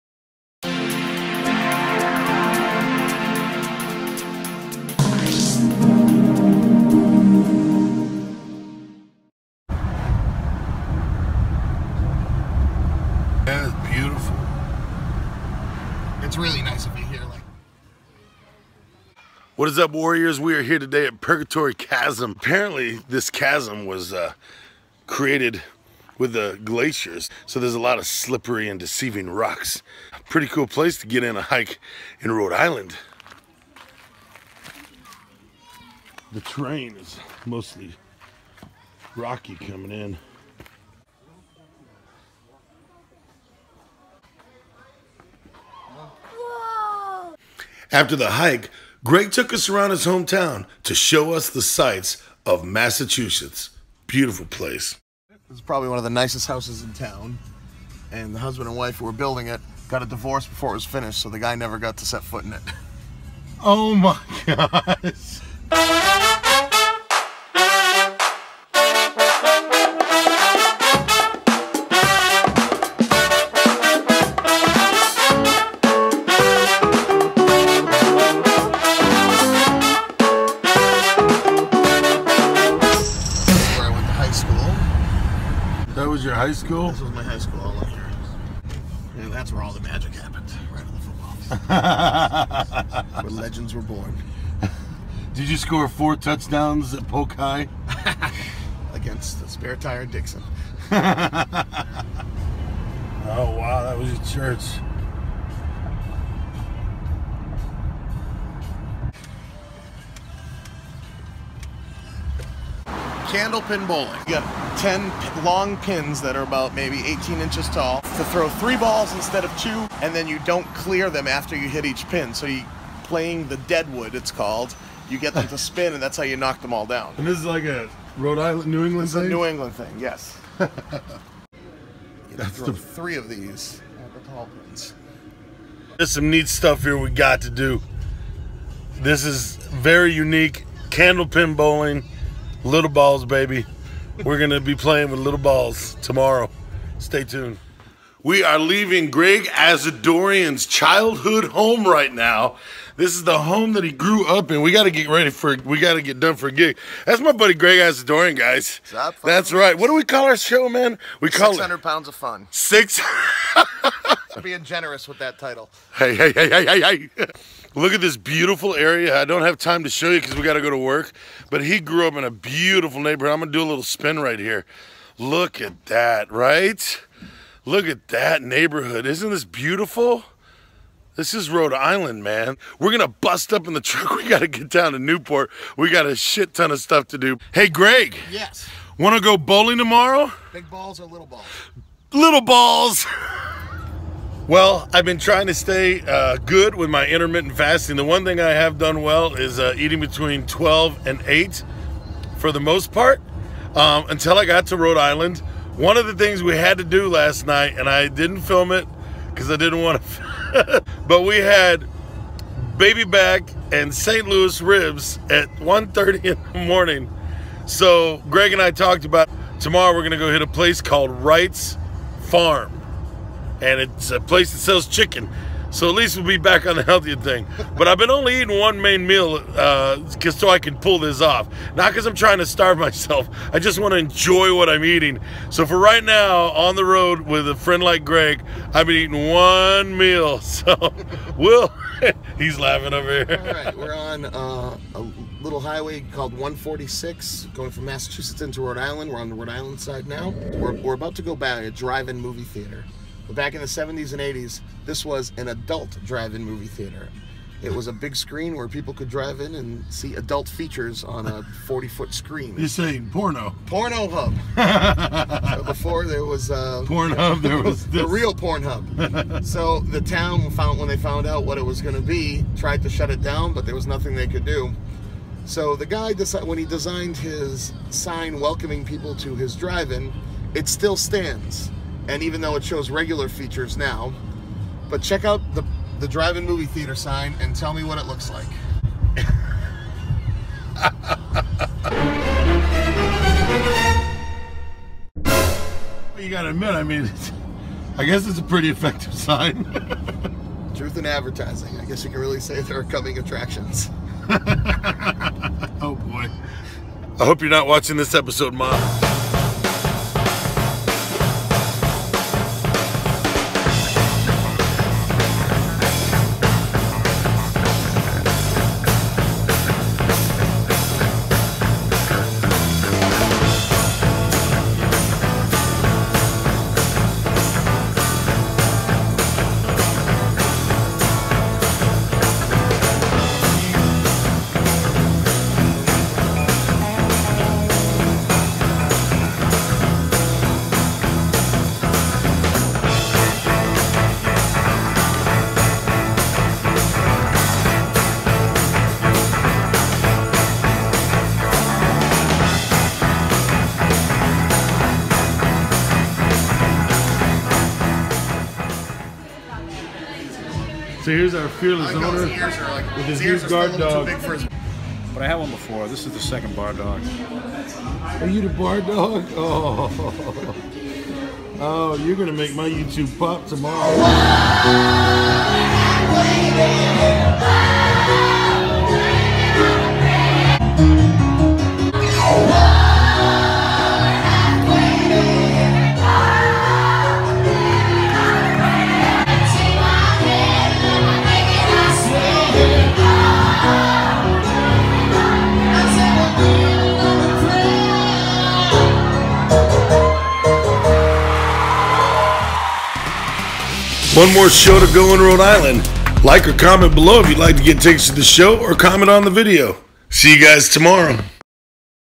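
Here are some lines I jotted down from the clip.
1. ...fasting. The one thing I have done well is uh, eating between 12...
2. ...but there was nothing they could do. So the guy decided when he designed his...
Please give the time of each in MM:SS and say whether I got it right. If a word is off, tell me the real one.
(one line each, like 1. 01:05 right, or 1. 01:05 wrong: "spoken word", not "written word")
1. 03:17 right
2. 04:33 right.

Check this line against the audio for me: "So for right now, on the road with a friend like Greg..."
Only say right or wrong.
right.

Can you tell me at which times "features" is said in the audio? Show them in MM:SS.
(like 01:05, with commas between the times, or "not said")
04:20, 04:43.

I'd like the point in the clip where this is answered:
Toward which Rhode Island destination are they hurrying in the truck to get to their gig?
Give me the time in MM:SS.
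03:04.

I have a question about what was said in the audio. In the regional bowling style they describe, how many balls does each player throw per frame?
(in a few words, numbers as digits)
3.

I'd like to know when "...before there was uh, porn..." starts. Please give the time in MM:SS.
04:25.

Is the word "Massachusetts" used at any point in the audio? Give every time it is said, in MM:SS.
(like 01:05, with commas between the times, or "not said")
00:52, 04:07.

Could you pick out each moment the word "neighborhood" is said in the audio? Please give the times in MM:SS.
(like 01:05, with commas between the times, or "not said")
02:52, 02:58.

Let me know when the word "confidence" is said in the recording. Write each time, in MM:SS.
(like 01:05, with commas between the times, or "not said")
not said.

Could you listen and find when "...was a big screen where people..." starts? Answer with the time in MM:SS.
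04:17.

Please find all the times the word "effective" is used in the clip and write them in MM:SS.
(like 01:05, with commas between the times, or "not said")
04:58.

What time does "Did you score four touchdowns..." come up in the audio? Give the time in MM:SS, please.
01:35.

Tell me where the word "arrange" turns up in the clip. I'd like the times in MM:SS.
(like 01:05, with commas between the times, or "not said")
not said.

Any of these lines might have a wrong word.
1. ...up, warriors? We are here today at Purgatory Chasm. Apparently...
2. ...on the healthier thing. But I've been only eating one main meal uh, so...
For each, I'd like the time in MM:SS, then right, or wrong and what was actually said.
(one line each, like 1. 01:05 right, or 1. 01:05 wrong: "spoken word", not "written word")
1. 00:19 right
2. 03:46 right.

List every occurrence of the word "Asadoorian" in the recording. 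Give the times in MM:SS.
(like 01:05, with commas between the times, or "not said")
02:29, 02:37.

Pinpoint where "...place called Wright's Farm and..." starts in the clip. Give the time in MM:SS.
03:40.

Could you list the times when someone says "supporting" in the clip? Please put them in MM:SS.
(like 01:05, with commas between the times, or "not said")
not said.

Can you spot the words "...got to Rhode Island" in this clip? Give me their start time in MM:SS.
03:24.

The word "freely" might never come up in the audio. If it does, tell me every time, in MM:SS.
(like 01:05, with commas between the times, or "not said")
not said.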